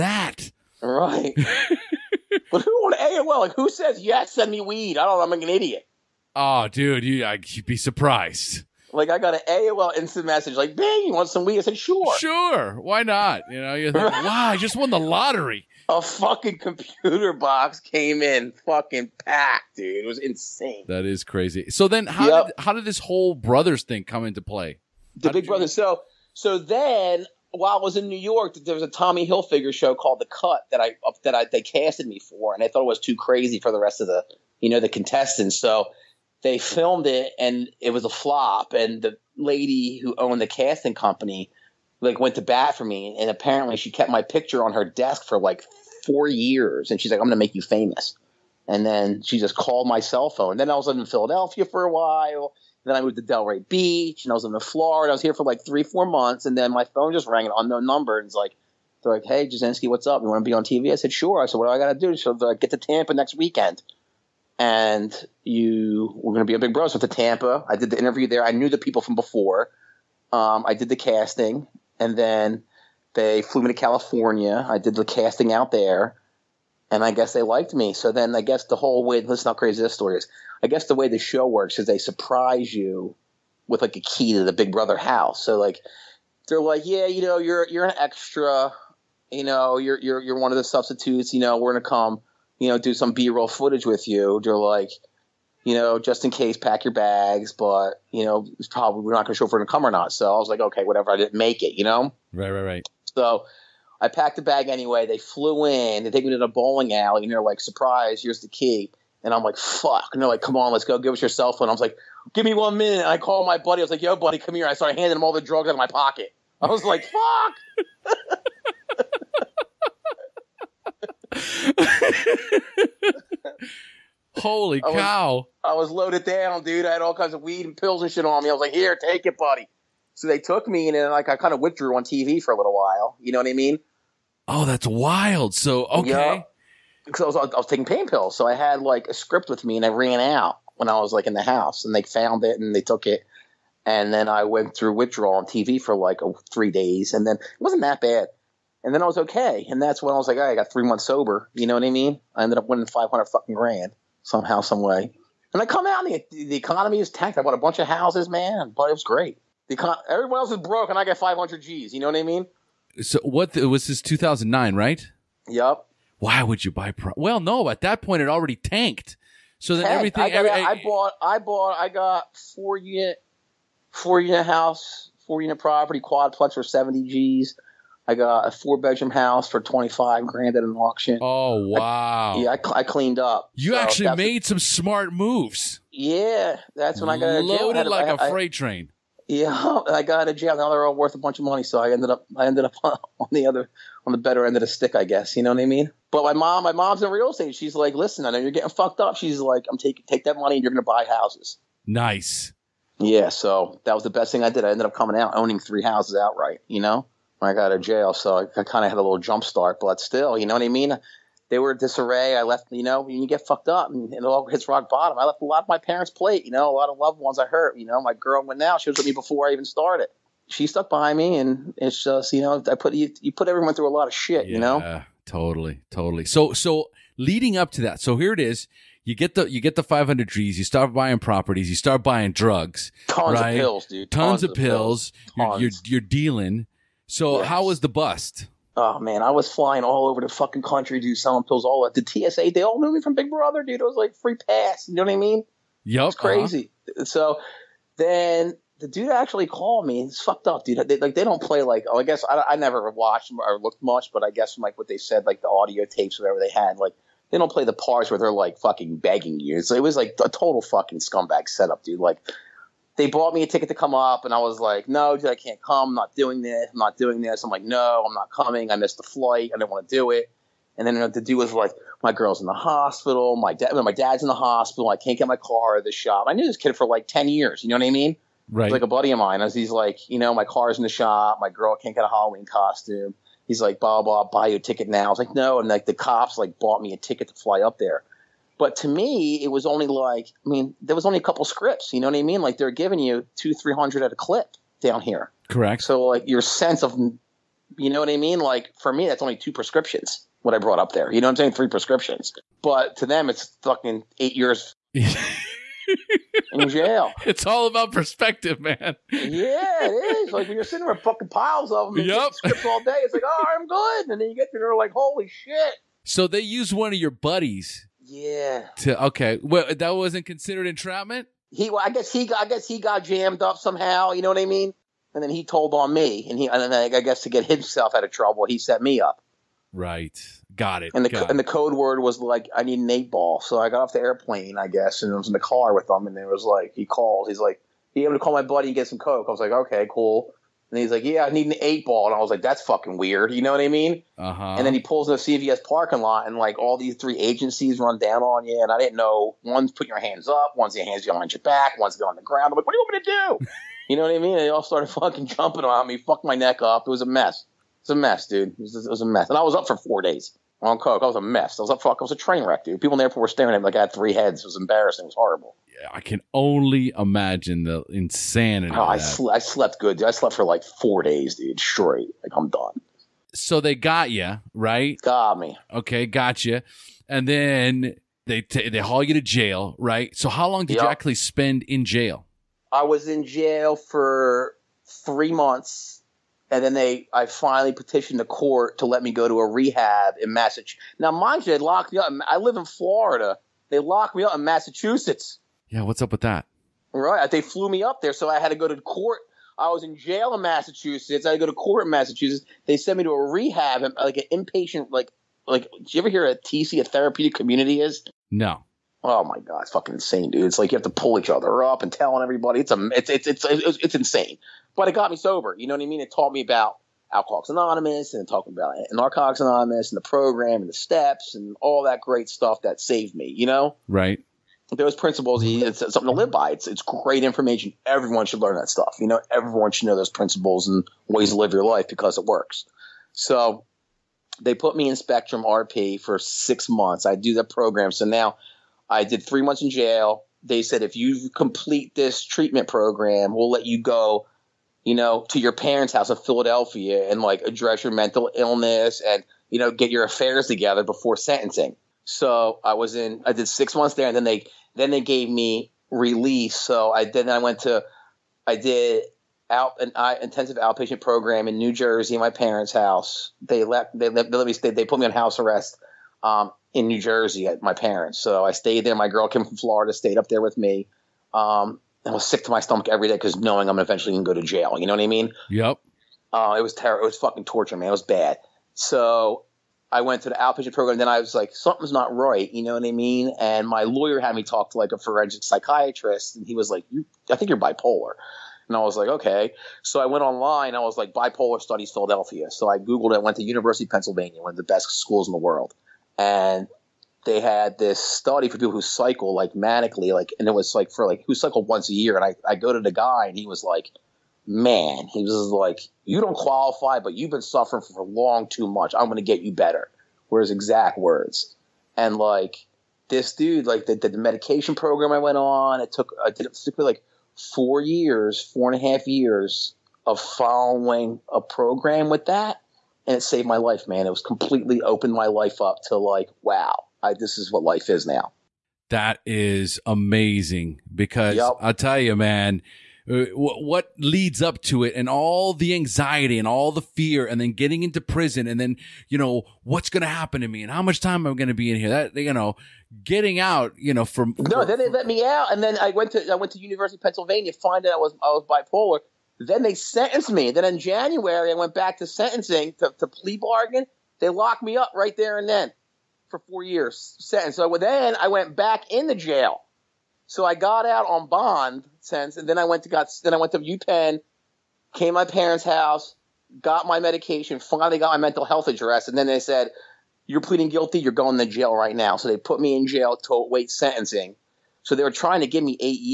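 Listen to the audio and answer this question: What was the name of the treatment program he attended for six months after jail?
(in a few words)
Spectrum RP.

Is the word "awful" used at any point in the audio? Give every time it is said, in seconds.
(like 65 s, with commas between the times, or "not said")
not said.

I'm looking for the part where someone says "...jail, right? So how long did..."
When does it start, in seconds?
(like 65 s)
379 s.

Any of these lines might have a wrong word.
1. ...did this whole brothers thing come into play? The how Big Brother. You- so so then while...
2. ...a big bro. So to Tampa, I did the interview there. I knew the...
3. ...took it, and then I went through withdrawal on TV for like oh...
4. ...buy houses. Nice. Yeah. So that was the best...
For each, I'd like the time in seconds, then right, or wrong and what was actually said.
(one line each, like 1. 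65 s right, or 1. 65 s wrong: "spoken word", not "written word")
1. 22 s right
2. 66 s right
3. 142 s right
4. 200 s right.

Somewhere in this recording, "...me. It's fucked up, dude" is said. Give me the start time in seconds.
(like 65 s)
249 s.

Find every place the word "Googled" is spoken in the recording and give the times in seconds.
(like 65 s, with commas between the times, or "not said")
492 s.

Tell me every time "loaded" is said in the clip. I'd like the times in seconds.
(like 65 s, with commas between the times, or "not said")
125 s, 187 s.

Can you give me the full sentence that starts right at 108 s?
Here's the key." And I'm like, "Fuck!" And they're like, "Come on, let's go.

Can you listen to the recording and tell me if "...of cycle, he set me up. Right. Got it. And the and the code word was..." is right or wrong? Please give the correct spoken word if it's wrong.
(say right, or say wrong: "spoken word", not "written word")
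wrong: "trouble", not "cycle".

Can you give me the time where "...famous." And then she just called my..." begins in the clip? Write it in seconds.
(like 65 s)
47 s.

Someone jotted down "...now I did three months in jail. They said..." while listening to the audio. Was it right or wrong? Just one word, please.
right.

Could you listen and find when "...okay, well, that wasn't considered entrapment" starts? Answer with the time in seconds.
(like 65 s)
319 s.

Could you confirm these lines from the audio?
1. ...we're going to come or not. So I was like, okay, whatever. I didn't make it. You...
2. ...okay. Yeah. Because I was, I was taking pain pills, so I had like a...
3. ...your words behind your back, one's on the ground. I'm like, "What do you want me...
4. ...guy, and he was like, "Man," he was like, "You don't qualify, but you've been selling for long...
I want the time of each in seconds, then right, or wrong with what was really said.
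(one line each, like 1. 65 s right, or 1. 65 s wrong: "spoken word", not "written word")
1. 99 s right
2. 135 s right
3. 350 s wrong: "hands", not "words"
4. 502 s wrong: "suffering", not "selling".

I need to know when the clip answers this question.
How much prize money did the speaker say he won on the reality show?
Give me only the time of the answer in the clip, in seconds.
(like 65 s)
152 s.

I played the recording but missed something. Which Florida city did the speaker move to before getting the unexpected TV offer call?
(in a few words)
Delray Beach.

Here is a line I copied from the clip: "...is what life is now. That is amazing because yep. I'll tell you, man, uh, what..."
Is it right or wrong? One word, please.
right.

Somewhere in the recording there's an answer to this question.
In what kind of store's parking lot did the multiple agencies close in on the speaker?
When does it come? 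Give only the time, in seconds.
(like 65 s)
345 s.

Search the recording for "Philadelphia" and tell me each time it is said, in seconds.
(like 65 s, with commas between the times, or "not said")
51 s, 446 s, 491 s.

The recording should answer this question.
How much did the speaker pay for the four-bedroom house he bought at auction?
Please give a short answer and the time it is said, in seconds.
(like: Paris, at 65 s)
25 grand, at 179 s.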